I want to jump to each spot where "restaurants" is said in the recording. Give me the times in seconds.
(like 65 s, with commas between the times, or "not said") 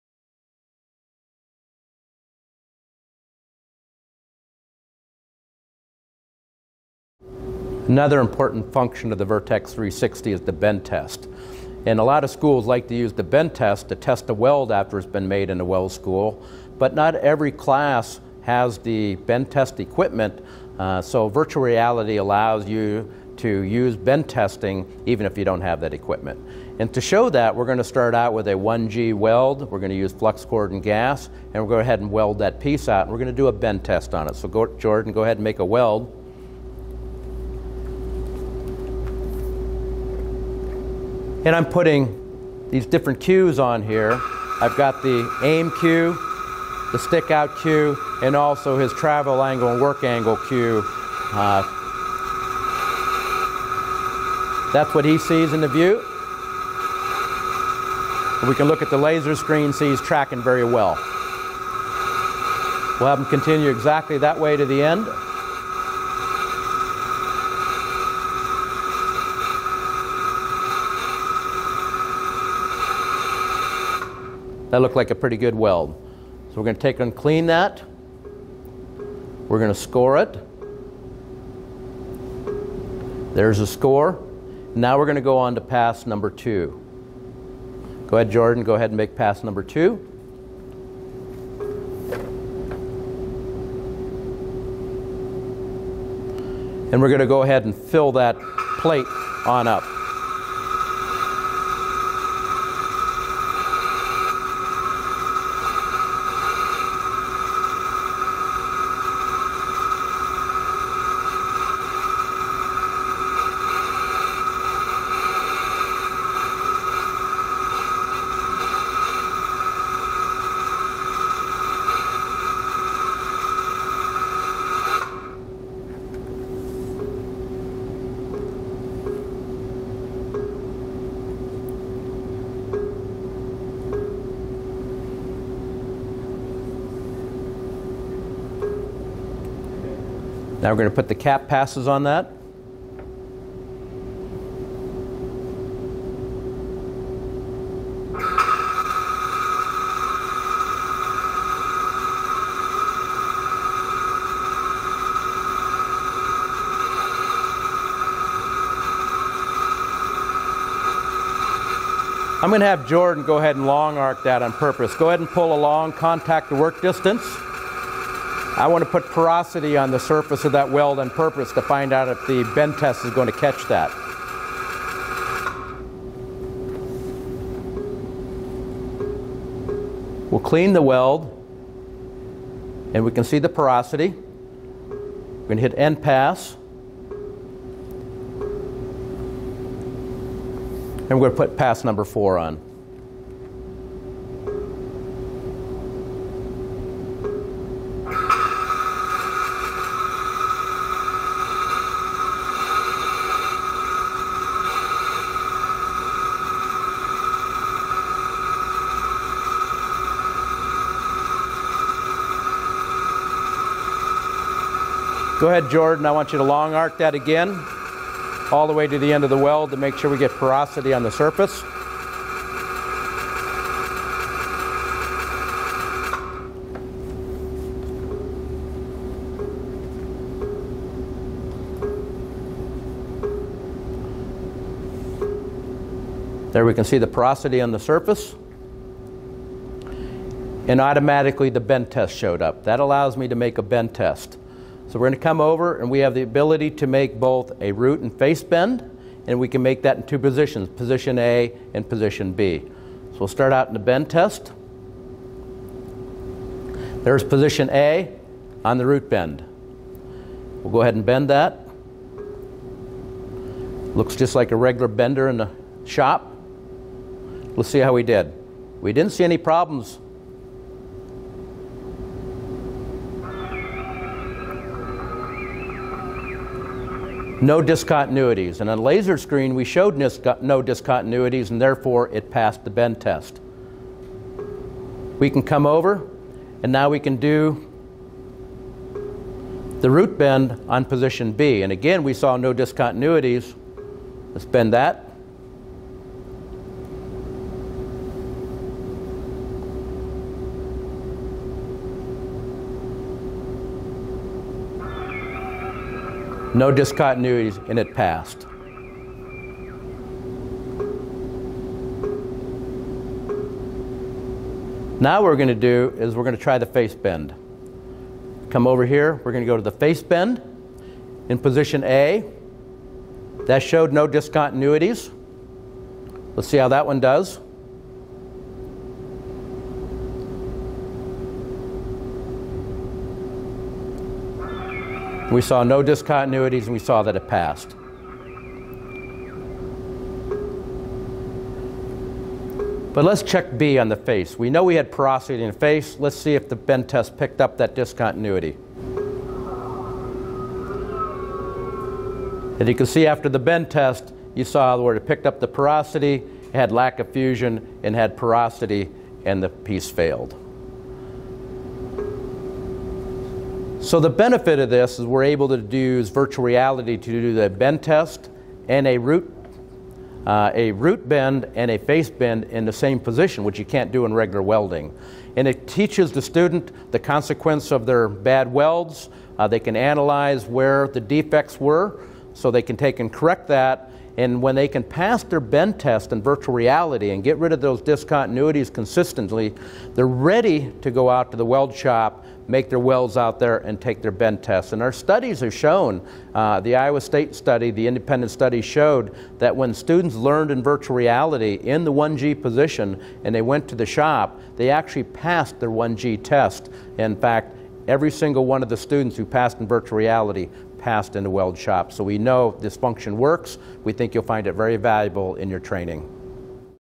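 not said.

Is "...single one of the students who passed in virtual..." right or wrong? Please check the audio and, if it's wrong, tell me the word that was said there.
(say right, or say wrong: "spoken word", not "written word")
right.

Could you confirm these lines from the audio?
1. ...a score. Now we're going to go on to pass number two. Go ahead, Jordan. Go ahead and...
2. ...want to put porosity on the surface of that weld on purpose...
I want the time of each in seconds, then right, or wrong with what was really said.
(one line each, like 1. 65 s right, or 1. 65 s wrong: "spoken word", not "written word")
1. 83 s right
2. 168 s right.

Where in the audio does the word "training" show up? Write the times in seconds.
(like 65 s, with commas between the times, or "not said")
415 s.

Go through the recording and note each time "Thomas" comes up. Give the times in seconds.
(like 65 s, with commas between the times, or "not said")
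not said.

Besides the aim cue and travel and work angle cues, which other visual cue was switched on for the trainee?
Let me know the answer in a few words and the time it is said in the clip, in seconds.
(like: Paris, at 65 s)
stick out cue, at 46 s.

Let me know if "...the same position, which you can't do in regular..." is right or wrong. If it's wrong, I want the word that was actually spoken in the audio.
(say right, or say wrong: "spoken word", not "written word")
right.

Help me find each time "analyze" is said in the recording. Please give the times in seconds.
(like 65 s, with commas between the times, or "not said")
379 s.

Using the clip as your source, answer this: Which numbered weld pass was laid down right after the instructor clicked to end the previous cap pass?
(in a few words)
4.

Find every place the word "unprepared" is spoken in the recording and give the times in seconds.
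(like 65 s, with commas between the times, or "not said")
not said.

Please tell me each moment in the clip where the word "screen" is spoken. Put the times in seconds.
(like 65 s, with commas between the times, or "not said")
59 s, 279 s.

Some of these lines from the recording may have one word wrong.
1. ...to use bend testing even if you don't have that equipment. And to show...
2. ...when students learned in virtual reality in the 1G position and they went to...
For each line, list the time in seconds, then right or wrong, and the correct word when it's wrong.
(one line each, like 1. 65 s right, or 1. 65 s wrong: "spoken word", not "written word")
1. 23 s right
2. 399 s right.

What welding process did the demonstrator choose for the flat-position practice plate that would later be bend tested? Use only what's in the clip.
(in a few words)
flux cored and gas.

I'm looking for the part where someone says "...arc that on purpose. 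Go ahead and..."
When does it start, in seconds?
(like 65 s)
163 s.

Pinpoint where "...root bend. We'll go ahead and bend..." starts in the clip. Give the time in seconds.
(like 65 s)
258 s.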